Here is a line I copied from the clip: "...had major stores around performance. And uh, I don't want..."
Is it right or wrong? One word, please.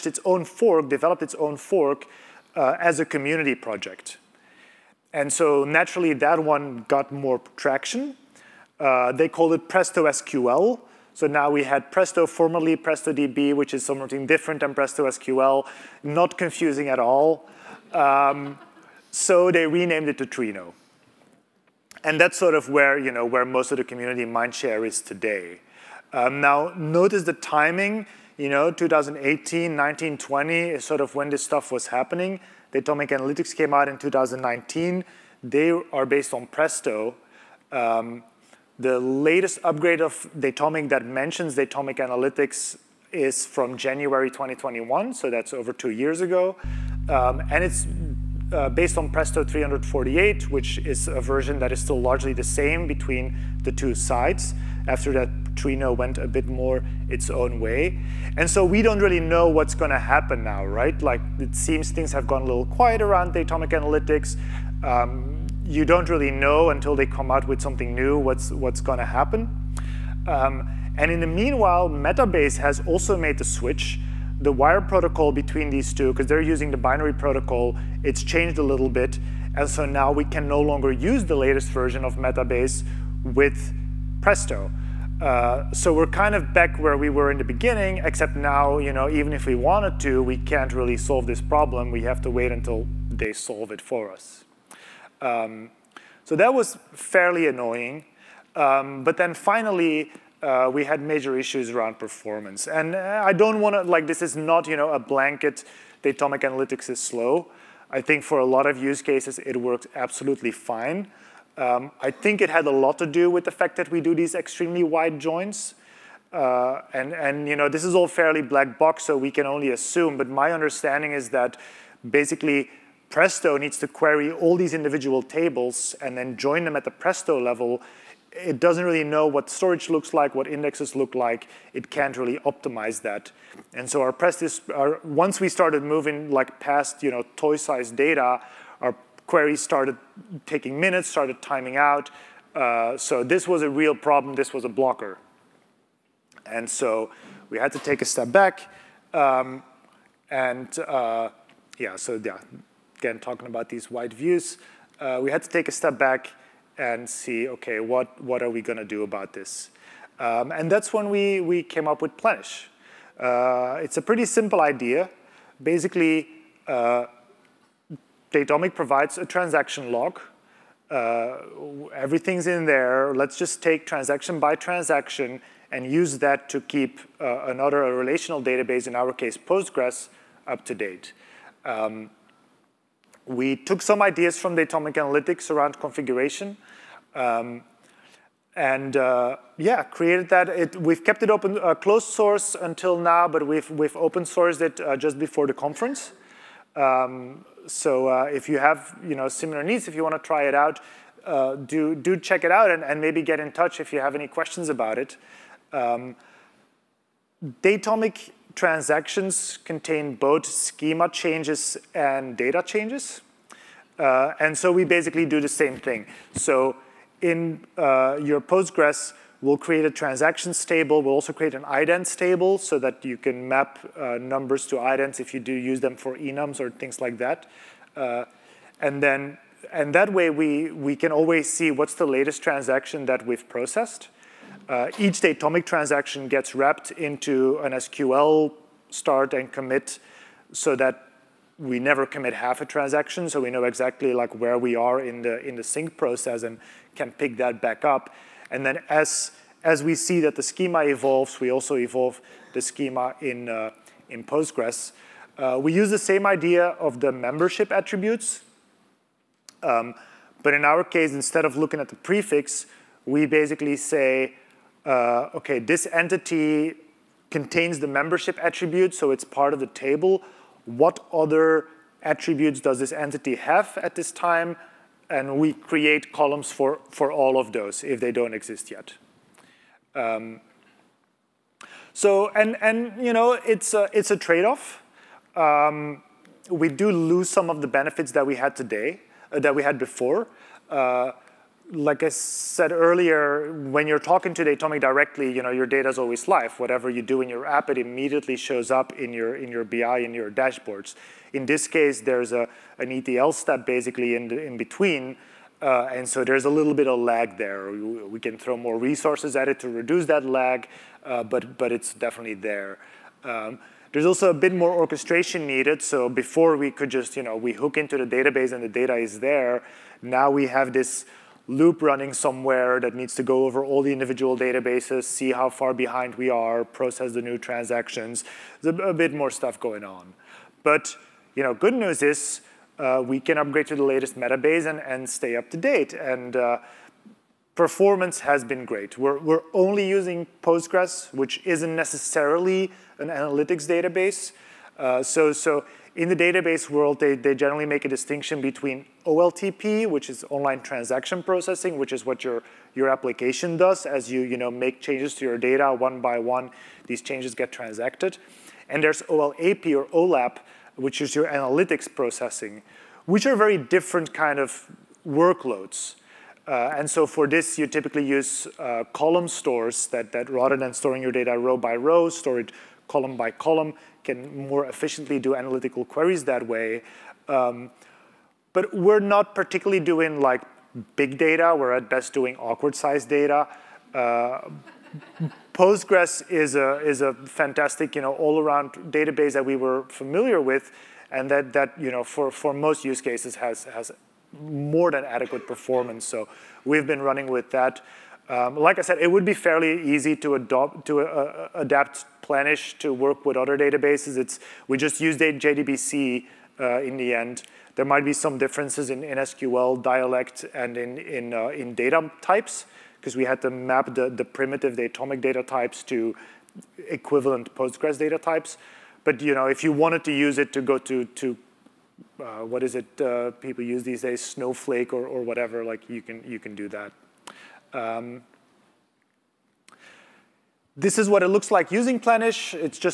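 wrong.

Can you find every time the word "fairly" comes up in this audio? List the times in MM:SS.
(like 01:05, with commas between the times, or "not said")
01:36, 01:58, 06:39.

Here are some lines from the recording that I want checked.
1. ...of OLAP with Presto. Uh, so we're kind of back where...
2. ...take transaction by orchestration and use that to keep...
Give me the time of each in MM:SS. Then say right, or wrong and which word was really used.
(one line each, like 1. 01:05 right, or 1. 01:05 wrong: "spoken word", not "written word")
1. 01:22 wrong: "Metabase", not "OLAP"
2. 02:53 wrong: "transaction", not "orchestration".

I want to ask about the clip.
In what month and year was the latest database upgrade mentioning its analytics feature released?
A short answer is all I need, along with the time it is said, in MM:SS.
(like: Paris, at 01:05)
January 2021, at 00:43.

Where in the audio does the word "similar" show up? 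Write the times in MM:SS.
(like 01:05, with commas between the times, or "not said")
03:19.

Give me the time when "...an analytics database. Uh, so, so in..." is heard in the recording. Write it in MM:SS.
05:42.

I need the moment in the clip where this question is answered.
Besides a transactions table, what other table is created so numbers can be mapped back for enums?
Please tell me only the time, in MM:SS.
03:41.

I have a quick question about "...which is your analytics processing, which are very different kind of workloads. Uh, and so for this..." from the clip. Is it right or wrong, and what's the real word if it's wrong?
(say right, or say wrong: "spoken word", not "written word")
right.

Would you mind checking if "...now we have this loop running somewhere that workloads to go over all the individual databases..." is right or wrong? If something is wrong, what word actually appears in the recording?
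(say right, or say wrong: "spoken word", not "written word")
wrong: "needs", not "workloads".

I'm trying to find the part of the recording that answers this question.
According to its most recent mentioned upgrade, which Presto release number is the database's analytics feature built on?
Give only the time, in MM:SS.
00:49.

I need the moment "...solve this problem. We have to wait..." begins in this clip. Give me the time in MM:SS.
01:30.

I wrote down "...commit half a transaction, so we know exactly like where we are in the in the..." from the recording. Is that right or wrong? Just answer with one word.
right.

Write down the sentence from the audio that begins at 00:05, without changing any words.
And so naturally that one got more traction.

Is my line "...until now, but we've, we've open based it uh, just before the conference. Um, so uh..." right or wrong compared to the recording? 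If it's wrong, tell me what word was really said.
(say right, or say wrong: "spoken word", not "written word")
wrong: "sourced", not "based".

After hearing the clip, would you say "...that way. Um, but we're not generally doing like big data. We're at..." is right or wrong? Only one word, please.
wrong.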